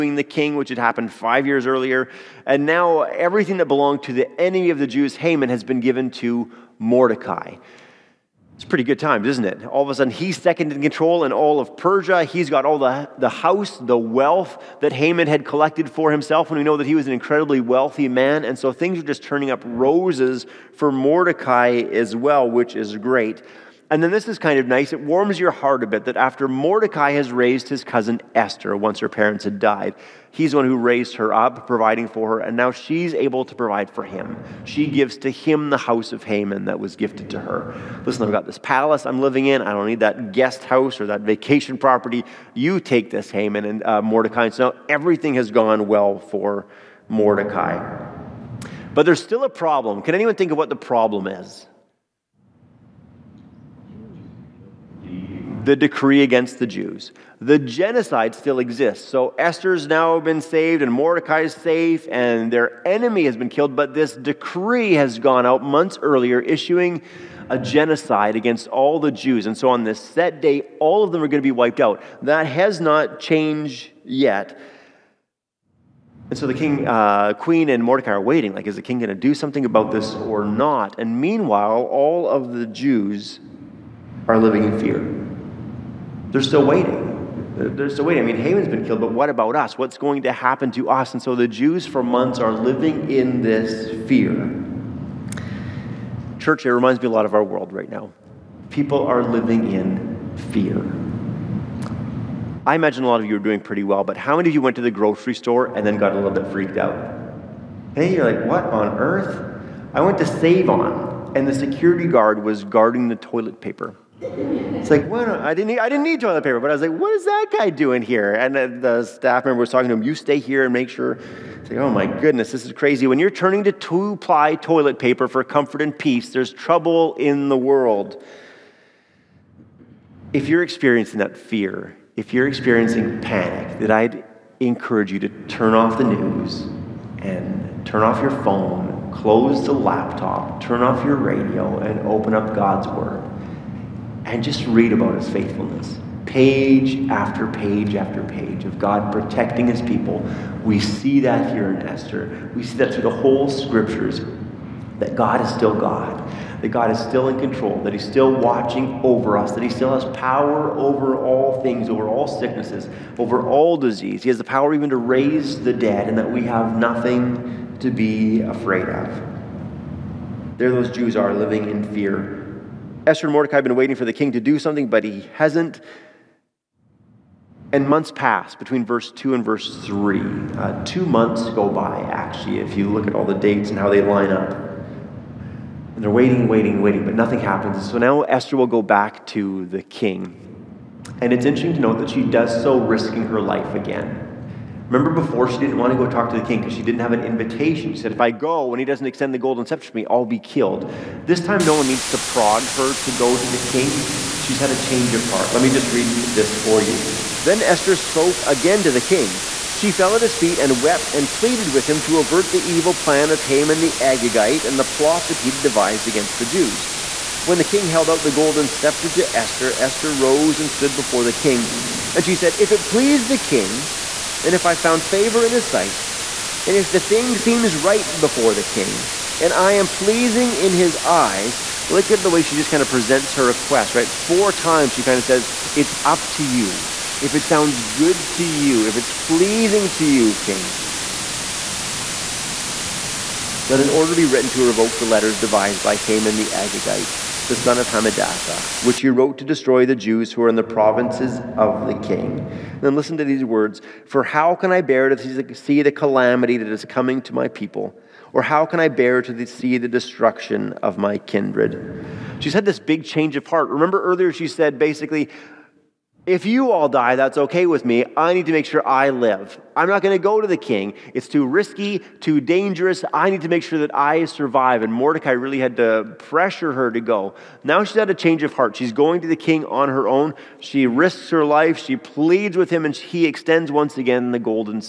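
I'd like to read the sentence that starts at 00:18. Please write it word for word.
And so things are just turning up roses for Mordecai as well, which is great.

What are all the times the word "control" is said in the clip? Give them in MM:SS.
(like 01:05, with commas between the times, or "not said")
00:10, 02:37.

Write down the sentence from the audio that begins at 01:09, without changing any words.
And so on this set day, all of them are going to be wiped out.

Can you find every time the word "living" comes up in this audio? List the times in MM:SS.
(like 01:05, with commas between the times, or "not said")
00:39, 01:24, 01:32, 01:39, 02:51.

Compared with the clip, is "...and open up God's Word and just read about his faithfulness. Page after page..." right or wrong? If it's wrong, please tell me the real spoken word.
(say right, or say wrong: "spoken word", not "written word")
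right.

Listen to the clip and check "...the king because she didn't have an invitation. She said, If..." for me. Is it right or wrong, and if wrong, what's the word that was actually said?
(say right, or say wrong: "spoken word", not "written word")
right.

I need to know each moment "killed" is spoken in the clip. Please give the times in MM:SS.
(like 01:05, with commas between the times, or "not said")
01:03, 01:28, 03:20.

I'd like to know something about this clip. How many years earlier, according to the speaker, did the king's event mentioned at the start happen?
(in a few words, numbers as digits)
5.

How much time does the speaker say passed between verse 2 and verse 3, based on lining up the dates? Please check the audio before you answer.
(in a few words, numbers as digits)
2 months.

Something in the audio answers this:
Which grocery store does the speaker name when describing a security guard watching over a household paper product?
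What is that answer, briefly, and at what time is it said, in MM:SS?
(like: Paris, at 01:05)
Save On, at 01:50.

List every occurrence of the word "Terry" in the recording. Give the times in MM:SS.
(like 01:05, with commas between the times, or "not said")
not said.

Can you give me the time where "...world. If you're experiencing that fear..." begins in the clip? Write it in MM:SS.
02:07.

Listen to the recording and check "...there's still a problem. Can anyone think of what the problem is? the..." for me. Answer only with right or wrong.
right.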